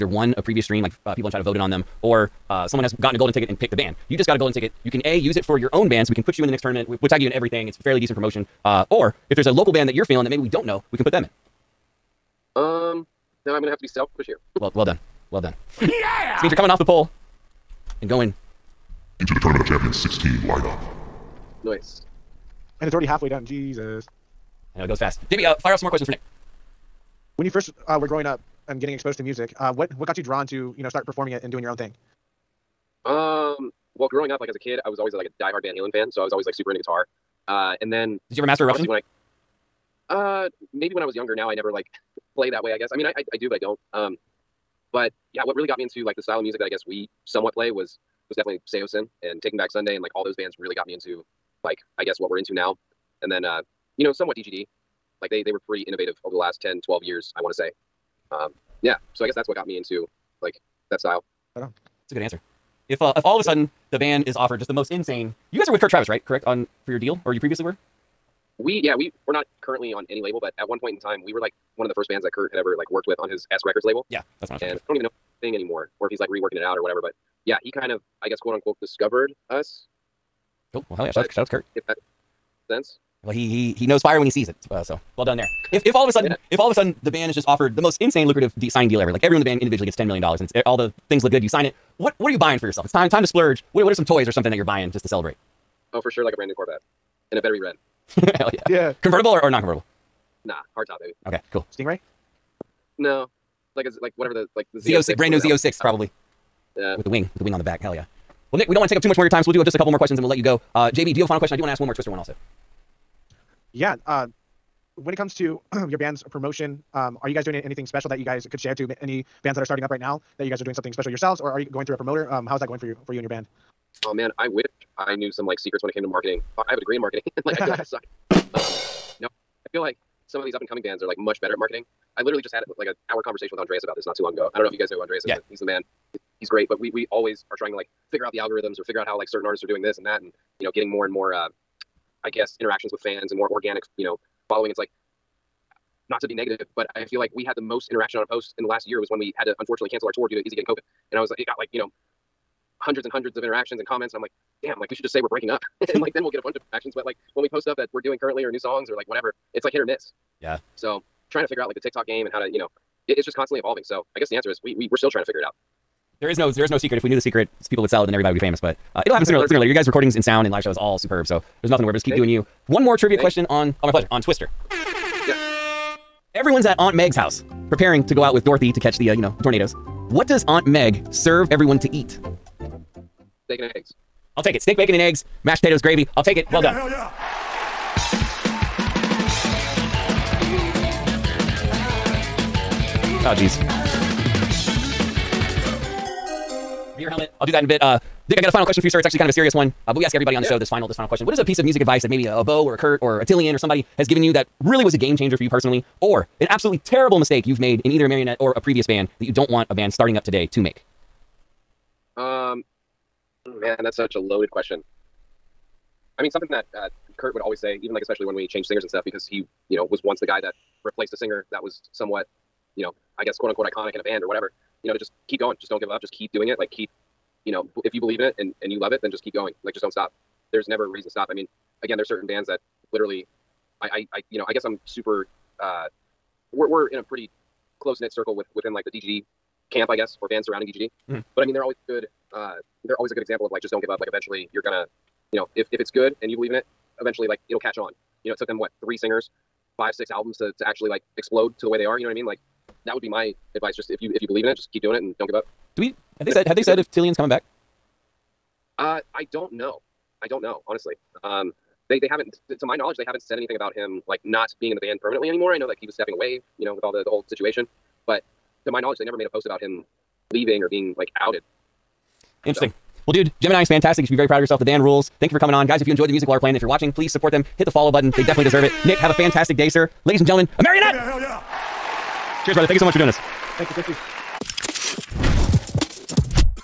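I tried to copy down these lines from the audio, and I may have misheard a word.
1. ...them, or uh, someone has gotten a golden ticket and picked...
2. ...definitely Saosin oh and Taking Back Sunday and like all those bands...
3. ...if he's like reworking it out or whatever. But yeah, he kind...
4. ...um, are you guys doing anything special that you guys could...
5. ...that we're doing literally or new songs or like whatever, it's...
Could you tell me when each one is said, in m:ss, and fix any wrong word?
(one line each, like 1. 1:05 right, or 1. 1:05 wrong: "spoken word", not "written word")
1. 0:01 right
2. 0:48 right
3. 1:16 right
4. 1:56 right
5. 2:37 wrong: "currently", not "literally".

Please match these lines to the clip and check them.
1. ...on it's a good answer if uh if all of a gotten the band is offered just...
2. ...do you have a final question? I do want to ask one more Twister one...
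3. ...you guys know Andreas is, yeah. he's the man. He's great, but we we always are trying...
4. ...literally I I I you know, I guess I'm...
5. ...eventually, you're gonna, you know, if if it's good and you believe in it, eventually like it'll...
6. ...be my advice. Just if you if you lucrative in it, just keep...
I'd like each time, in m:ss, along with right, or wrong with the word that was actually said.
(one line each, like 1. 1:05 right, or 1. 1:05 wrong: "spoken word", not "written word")
1. 1:01 wrong: "sudden", not "gotten"
2. 1:51 right
3. 2:14 right
4. 3:52 right
5. 4:04 right
6. 4:13 wrong: "believe", not "lucrative".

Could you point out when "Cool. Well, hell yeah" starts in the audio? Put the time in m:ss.
1:20.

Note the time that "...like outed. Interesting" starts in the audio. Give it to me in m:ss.
4:30.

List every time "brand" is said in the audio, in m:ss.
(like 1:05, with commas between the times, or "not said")
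1:36, 1:45.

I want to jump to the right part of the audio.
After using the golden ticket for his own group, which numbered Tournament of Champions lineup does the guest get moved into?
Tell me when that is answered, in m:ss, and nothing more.
0:19.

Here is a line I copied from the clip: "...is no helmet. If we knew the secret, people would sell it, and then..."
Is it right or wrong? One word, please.
wrong.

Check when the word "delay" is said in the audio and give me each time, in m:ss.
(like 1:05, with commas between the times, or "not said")
not said.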